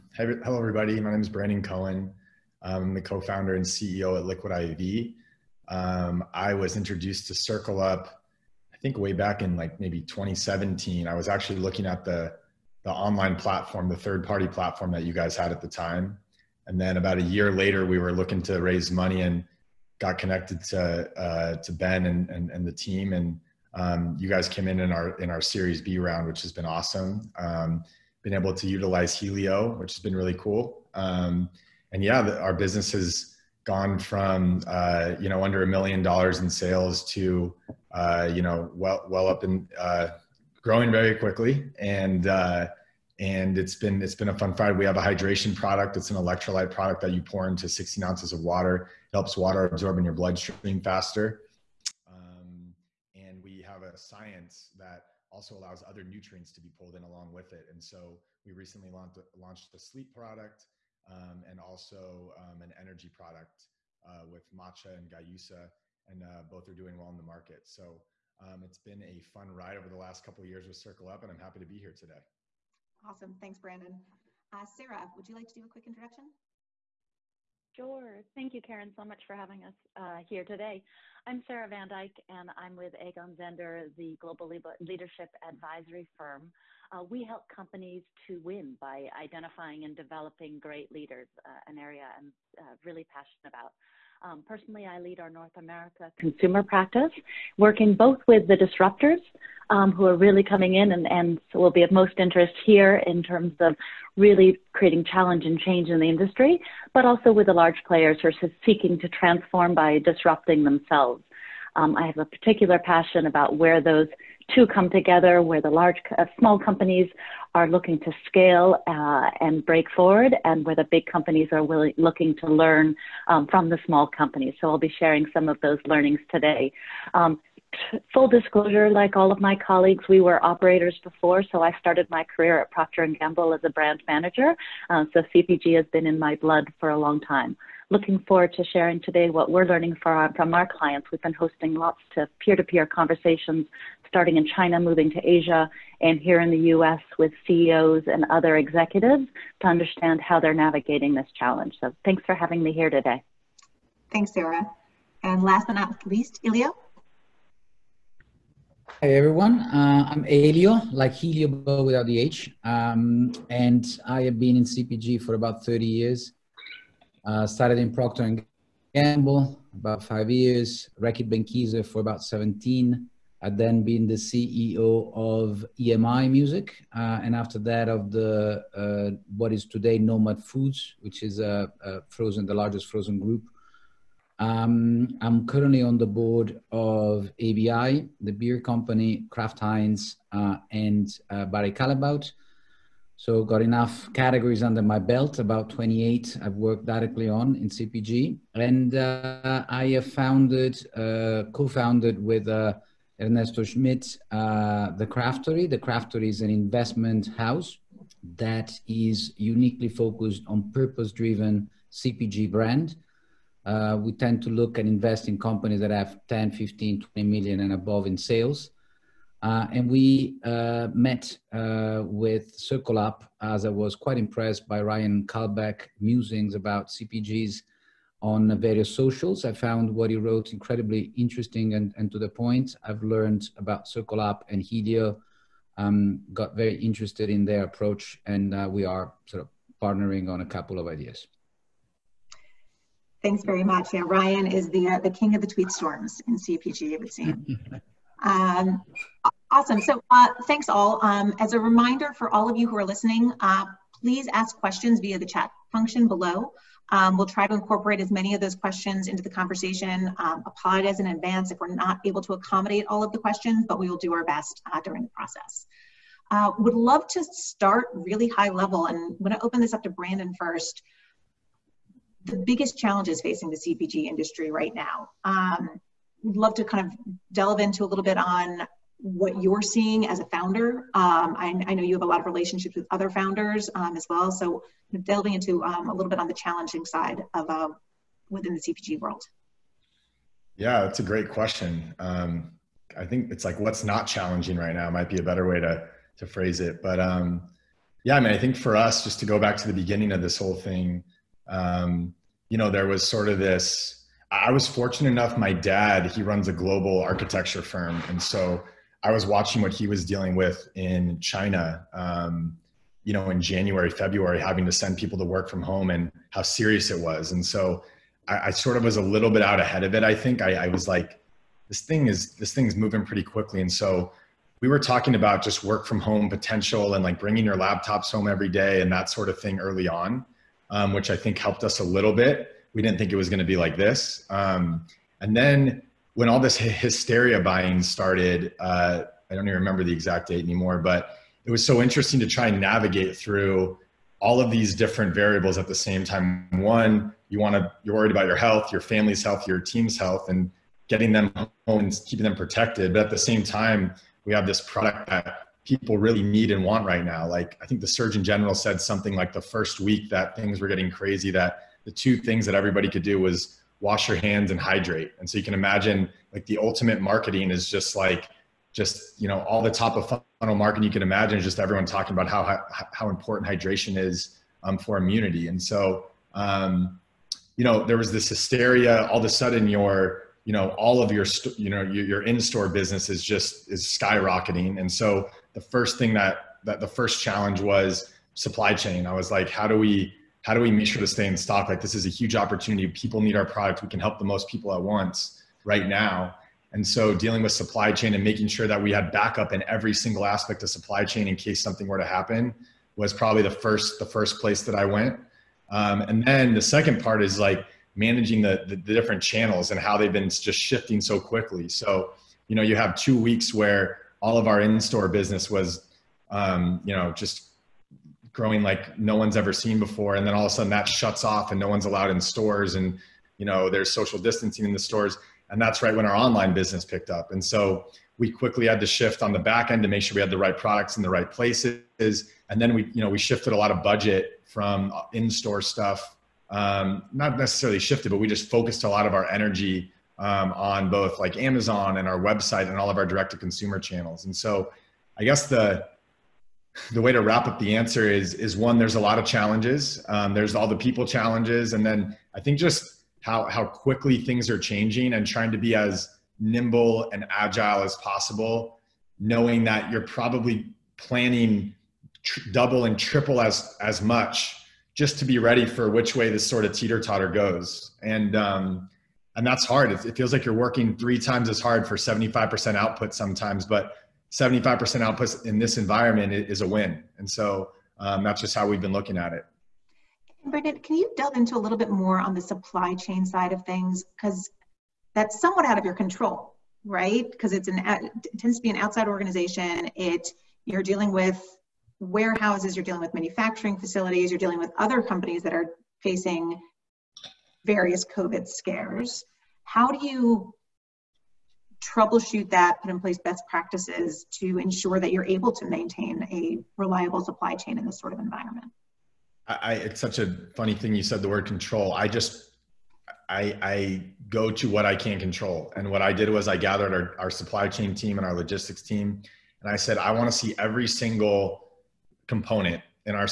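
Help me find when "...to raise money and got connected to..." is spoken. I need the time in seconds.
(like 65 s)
18 s.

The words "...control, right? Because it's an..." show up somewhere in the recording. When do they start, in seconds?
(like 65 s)
485 s.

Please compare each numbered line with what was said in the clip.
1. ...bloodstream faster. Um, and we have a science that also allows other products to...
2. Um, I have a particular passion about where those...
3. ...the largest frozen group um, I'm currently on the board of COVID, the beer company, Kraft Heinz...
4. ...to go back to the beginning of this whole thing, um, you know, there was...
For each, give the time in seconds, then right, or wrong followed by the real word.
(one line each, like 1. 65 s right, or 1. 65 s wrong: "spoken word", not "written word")
1. 50 s wrong: "nutrients", not "products"
2. 111 s right
3. 182 s wrong: "ABI", not "COVID"
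4. 299 s right.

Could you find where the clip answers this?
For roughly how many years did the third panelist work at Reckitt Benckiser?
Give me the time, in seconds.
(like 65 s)
172 s.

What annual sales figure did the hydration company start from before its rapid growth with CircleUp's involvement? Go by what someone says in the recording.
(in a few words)
under 1 million dollars.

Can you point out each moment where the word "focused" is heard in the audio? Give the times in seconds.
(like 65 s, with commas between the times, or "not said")
209 s, 438 s.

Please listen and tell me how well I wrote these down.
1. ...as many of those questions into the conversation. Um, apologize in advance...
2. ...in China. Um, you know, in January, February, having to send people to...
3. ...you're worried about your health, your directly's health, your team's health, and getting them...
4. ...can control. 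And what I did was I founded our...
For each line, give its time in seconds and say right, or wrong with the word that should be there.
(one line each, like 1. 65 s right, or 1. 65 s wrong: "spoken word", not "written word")
1. 258 s right
2. 310 s right
3. 347 s wrong: "family", not "directly"
4. 514 s wrong: "gathered", not "founded".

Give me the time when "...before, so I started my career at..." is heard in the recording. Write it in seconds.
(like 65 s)
131 s.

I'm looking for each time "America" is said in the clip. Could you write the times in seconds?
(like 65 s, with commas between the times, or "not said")
95 s.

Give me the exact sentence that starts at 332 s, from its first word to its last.
We didn't think it was going to be like this.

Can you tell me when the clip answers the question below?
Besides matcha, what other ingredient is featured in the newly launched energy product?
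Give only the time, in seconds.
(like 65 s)
65 s.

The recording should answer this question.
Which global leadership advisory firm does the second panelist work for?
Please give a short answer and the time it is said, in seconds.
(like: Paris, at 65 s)
Egon Zehnder, at 82 s.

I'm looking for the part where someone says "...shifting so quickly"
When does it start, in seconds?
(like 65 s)
410 s.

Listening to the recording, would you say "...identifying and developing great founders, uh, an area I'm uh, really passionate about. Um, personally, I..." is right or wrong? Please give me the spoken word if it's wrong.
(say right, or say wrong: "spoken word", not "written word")
wrong: "leaders", not "founders".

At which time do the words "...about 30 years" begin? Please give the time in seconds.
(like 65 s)
165 s.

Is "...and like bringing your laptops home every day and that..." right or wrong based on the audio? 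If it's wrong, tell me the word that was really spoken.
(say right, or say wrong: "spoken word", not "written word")
right.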